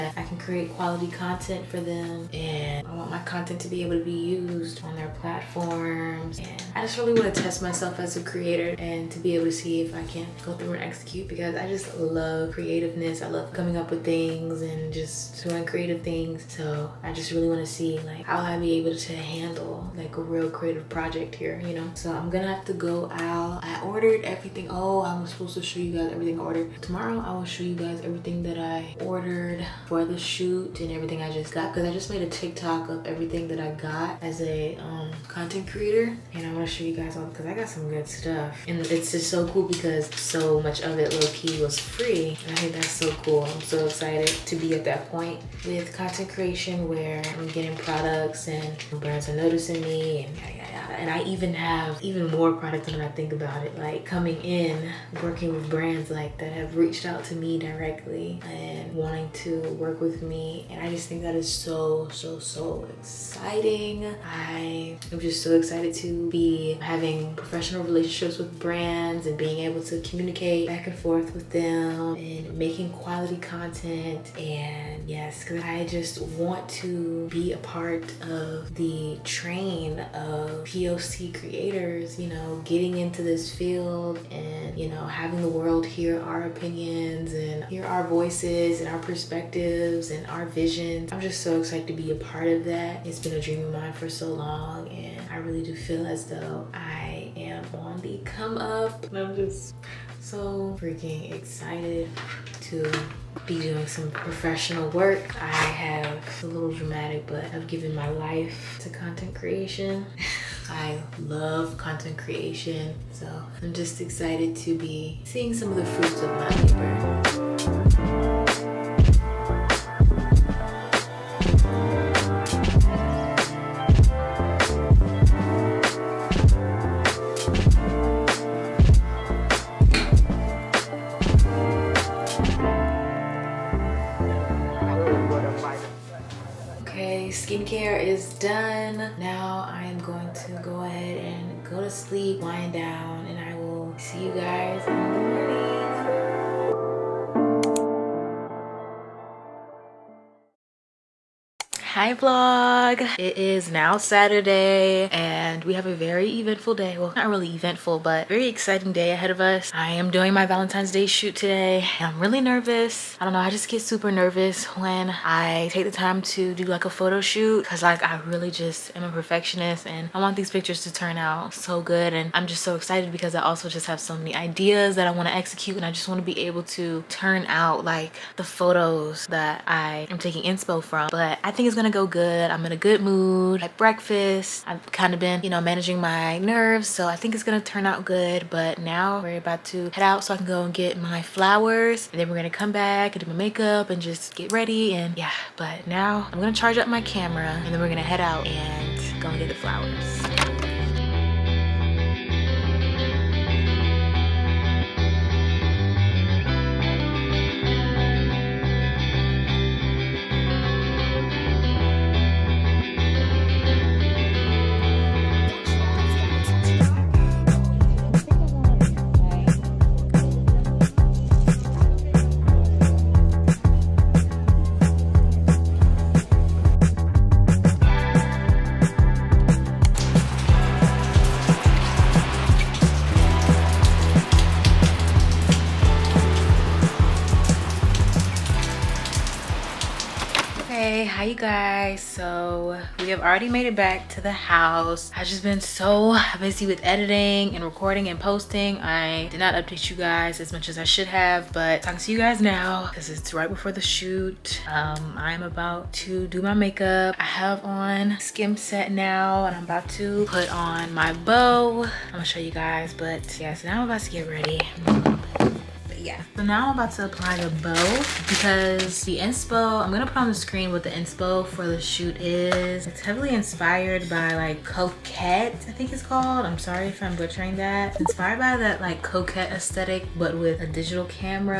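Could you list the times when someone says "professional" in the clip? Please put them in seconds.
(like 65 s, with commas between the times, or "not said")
67 s, 104 s.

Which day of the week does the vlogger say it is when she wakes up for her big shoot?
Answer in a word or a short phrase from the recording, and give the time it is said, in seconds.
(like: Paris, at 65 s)
Saturday, at 153 s.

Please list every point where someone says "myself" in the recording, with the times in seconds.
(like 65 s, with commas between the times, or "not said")
7 s.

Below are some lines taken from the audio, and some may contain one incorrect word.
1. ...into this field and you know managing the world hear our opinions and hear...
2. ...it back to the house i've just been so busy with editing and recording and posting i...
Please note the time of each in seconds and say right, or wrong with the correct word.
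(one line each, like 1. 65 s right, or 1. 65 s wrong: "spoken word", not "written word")
1. 82 s wrong: "having", not "managing"
2. 243 s right.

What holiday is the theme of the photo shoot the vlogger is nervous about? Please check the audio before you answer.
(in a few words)
Valentine's Day.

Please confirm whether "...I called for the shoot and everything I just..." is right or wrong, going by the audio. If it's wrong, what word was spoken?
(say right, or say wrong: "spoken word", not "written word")
wrong: "ordered", not "called".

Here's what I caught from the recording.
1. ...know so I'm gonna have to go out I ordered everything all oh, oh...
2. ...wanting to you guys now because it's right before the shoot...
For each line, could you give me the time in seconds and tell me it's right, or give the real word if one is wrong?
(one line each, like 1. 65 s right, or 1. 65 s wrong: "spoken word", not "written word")
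1. 21 s right
2. 251 s wrong: "talking", not "wanting".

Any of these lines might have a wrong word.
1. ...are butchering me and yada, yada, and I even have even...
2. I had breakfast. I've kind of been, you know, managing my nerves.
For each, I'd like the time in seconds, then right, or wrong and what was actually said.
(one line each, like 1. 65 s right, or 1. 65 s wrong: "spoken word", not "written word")
1. 49 s wrong: "noticing", not "butchering"
2. 183 s right.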